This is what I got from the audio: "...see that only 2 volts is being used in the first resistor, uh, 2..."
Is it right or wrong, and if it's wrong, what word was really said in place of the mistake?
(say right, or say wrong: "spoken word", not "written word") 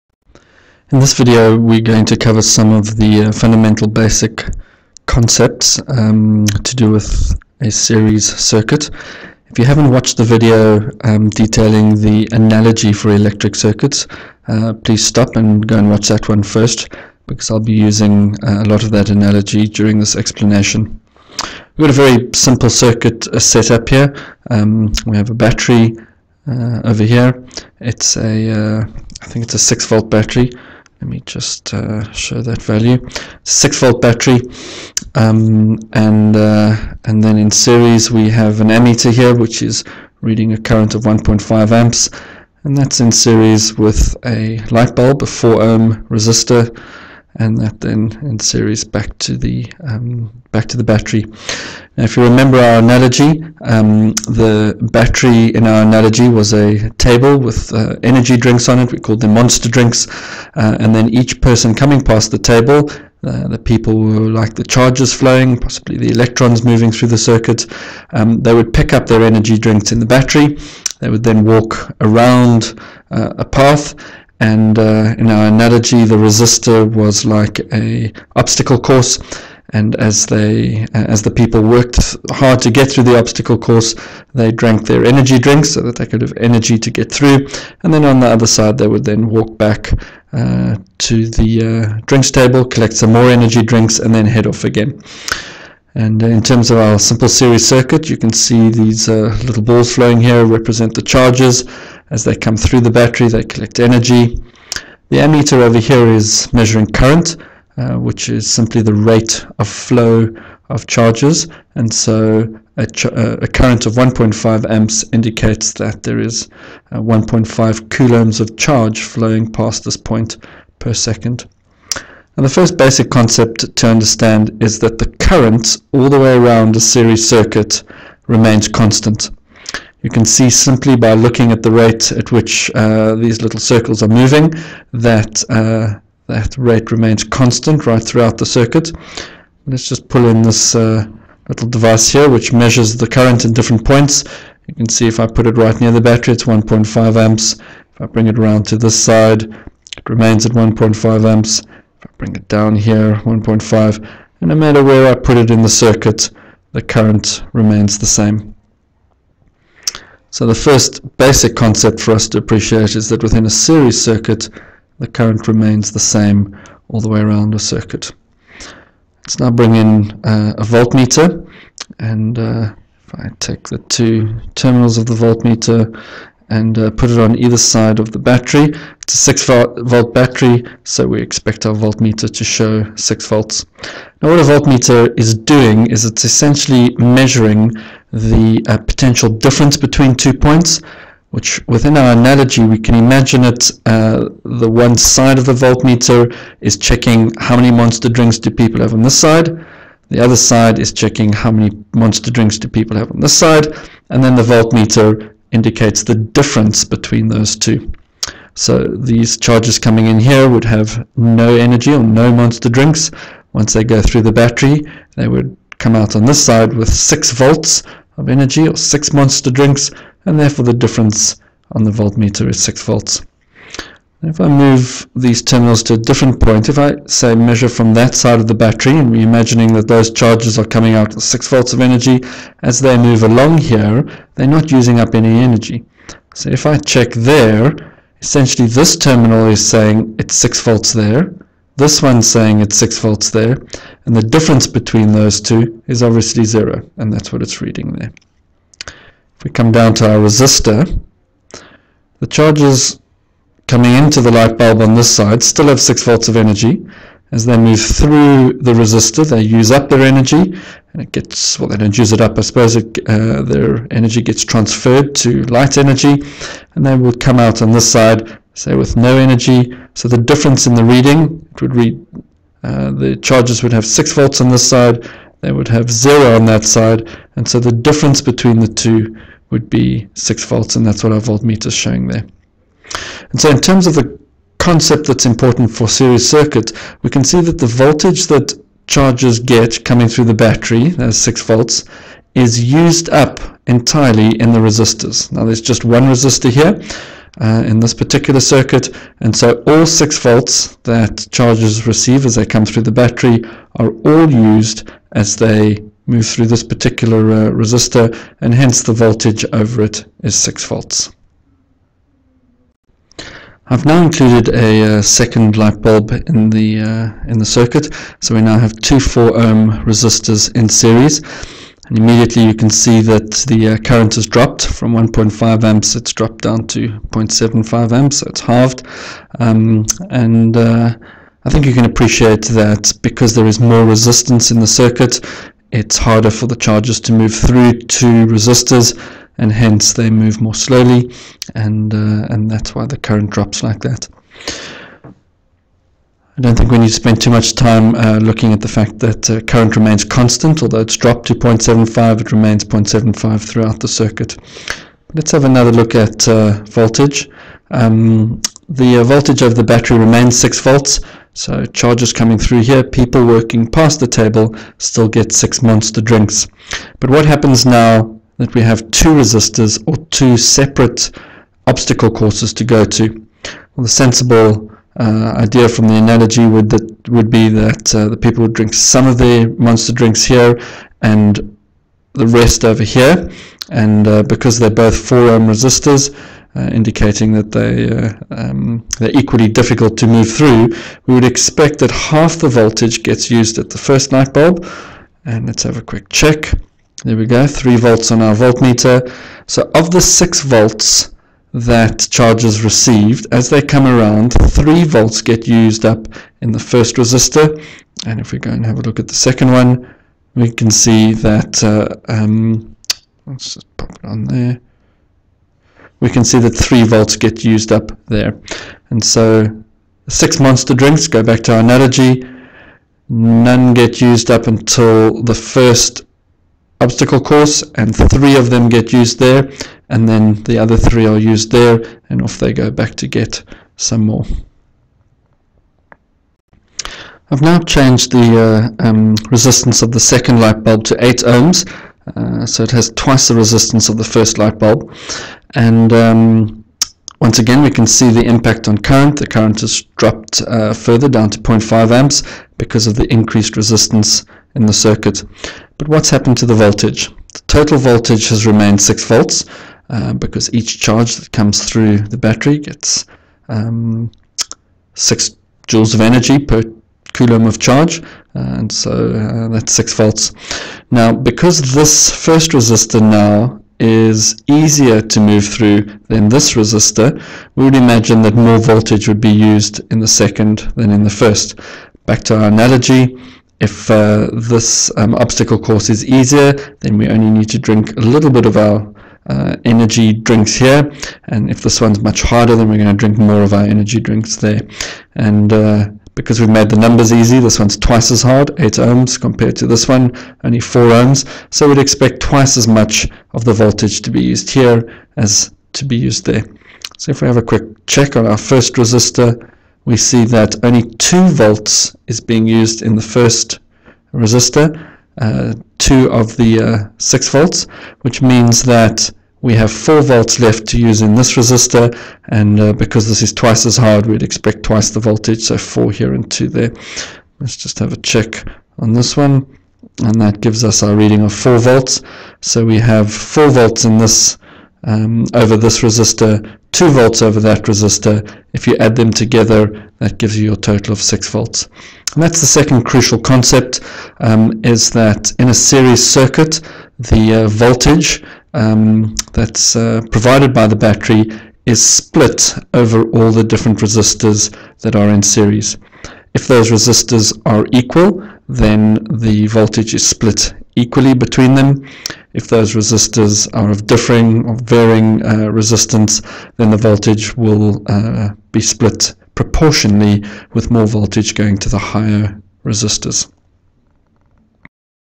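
right.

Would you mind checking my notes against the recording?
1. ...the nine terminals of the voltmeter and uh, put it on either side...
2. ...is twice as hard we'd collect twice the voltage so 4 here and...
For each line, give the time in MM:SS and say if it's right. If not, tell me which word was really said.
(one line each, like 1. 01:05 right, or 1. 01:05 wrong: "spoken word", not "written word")
1. 02:53 wrong: "two", not "nine"
2. 08:43 wrong: "expect", not "collect".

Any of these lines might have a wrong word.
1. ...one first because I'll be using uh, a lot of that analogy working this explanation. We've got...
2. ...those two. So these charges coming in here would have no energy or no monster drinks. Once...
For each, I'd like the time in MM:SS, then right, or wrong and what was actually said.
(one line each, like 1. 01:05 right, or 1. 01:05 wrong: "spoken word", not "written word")
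1. 00:16 wrong: "during", not "working"
2. 03:27 right.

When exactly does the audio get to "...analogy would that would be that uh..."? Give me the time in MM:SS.
06:15.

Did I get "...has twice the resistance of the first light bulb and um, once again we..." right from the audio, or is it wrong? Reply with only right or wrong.
right.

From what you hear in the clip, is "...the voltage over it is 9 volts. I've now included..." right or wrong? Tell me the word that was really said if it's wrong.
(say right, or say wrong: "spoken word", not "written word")
wrong: "6", not "9".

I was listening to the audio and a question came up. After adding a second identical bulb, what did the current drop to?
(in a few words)
0.75 amps.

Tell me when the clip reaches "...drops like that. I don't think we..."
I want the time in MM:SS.
05:43.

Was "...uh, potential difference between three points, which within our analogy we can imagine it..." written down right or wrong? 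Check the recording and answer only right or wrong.
wrong.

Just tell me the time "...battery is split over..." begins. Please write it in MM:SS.
09:10.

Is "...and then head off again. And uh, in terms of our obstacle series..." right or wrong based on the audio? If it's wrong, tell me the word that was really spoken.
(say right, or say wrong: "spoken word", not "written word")
wrong: "simple", not "obstacle".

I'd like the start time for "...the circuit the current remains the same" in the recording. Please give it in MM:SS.
02:35.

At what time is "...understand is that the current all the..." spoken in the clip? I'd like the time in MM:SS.
02:03.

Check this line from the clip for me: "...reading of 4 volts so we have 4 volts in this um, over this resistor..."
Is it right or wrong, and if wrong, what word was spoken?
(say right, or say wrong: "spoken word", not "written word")
right.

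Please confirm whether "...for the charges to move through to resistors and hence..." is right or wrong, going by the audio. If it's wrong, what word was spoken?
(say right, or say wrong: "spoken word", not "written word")
right.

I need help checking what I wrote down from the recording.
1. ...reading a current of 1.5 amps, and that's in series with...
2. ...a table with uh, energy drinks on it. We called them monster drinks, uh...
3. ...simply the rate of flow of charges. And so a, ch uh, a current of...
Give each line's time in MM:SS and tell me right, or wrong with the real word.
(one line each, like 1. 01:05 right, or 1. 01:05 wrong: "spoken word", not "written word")
1. 00:40 right
2. 00:56 right
3. 01:48 right.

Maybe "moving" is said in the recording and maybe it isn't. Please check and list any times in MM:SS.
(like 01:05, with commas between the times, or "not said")
01:06, 02:14.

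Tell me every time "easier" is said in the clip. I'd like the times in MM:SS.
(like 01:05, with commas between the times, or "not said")
07:54, 08:06.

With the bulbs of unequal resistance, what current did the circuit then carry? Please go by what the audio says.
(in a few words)
0.5 amps.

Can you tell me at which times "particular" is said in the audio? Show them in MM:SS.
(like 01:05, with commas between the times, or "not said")
04:57, 05:06.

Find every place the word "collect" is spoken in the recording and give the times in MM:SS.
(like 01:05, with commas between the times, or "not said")
01:32, 01:43.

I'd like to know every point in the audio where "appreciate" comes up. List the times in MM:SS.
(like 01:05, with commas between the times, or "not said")
02:42, 05:31.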